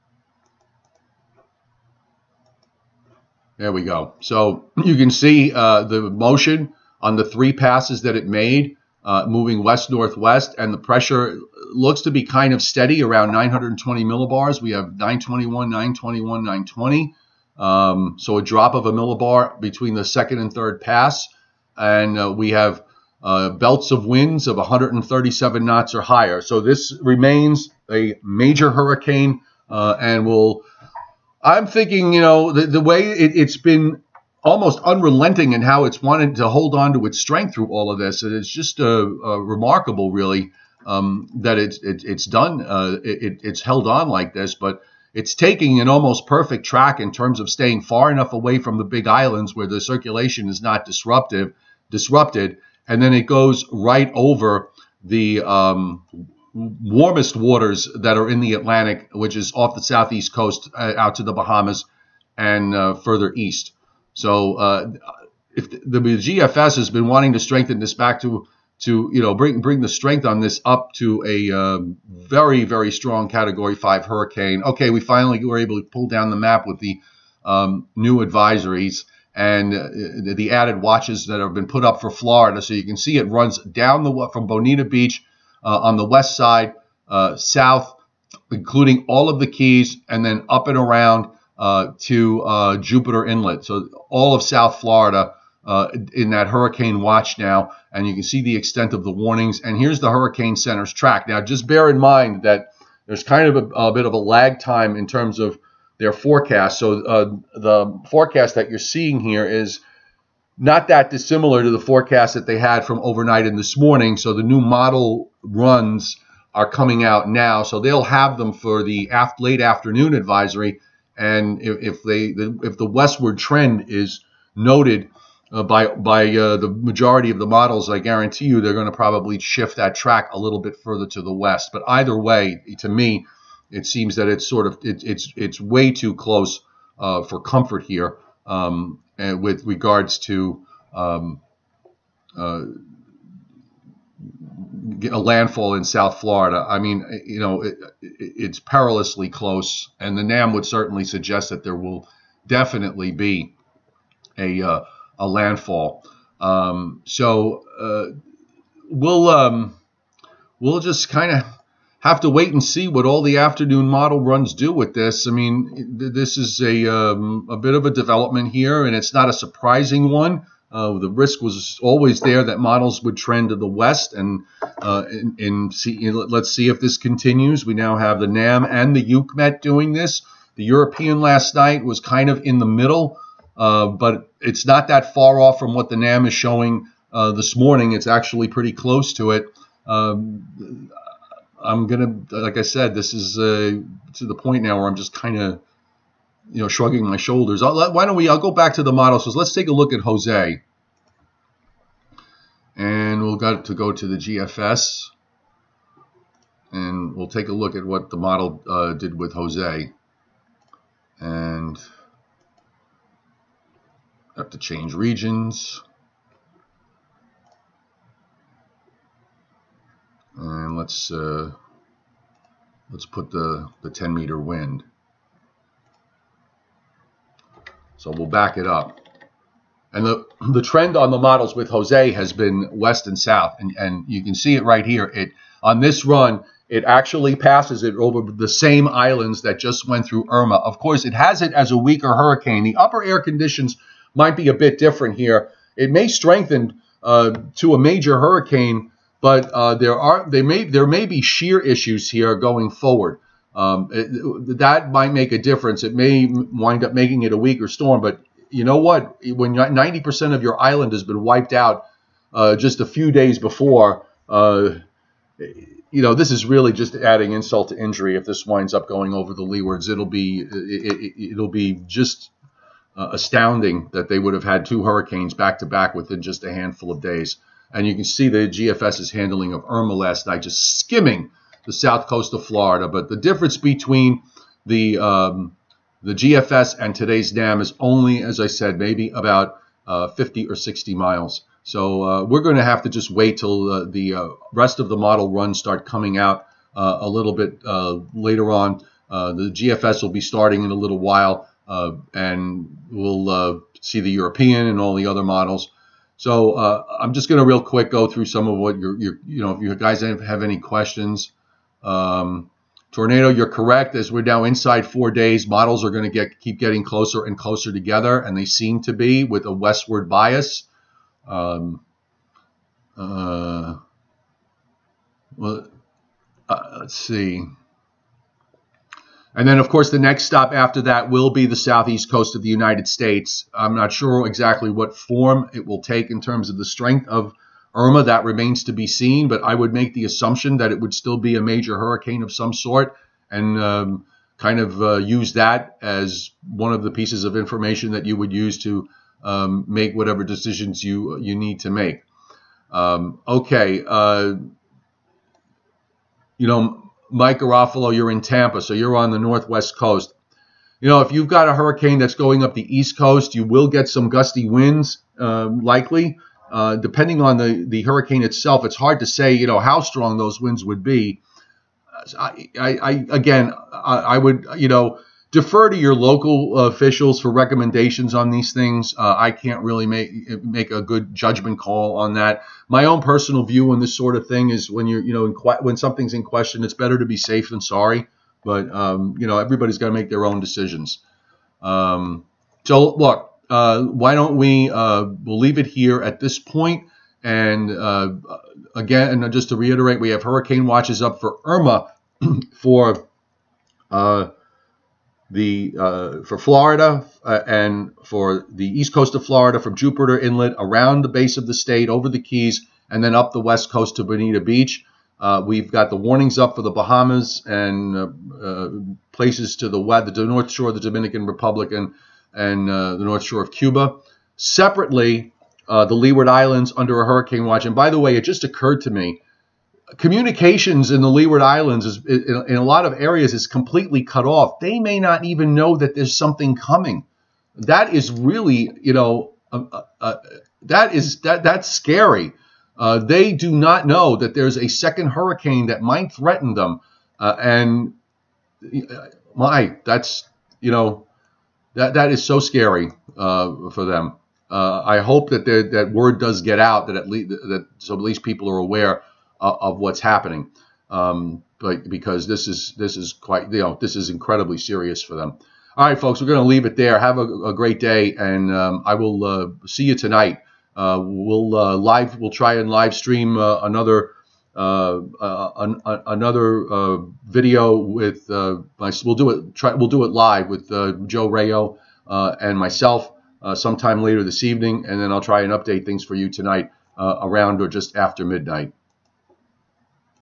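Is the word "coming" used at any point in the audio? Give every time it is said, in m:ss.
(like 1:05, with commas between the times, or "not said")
1:56, 4:55, 7:16.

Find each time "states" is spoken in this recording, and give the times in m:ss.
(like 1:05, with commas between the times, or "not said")
5:32, 6:51.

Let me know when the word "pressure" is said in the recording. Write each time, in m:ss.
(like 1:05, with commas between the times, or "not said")
0:10.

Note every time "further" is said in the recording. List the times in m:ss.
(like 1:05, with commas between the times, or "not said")
1:02, 2:10.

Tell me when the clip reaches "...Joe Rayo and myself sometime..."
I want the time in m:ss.
8:01.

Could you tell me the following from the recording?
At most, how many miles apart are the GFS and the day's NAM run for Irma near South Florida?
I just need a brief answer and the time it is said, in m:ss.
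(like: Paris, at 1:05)
60, at 4:50.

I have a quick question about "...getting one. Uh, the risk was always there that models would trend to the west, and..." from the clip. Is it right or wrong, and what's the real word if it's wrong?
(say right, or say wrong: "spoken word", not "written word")
wrong: "surprising", not "getting".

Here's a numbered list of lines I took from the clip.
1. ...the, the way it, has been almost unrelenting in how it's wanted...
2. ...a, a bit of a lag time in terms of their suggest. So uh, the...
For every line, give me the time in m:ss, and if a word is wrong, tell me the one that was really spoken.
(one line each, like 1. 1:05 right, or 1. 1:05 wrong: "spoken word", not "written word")
1. 0:32 right
2. 1:43 wrong: "forecast", not "suggest".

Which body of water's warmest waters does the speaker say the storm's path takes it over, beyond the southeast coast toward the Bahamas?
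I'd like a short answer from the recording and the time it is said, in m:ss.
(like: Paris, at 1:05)
Atlantic, at 0:58.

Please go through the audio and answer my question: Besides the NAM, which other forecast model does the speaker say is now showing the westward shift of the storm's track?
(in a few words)
UKMET.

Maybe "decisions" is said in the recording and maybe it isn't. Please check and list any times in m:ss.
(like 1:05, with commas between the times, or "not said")
5:50, 6:30.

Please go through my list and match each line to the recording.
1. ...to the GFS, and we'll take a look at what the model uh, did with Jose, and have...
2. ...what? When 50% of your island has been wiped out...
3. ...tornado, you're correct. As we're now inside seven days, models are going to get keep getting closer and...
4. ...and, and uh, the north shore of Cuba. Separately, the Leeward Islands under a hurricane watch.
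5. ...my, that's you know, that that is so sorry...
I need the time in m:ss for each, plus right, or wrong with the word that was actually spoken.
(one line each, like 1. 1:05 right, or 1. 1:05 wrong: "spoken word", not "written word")
1. 3:23 right
2. 4:18 wrong: "90", not "50"
3. 5:12 wrong: "four", not "seven"
4. 7:01 right
5. 7:29 wrong: "scary", not "sorry".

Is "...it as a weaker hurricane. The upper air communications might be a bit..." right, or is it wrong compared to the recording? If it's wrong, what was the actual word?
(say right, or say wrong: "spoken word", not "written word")
wrong: "conditions", not "communications".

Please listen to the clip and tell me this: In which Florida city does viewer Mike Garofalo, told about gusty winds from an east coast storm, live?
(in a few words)
Tampa.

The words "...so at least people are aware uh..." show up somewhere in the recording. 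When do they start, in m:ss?
7:37.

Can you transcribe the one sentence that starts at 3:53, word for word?
And, and you can see it right here.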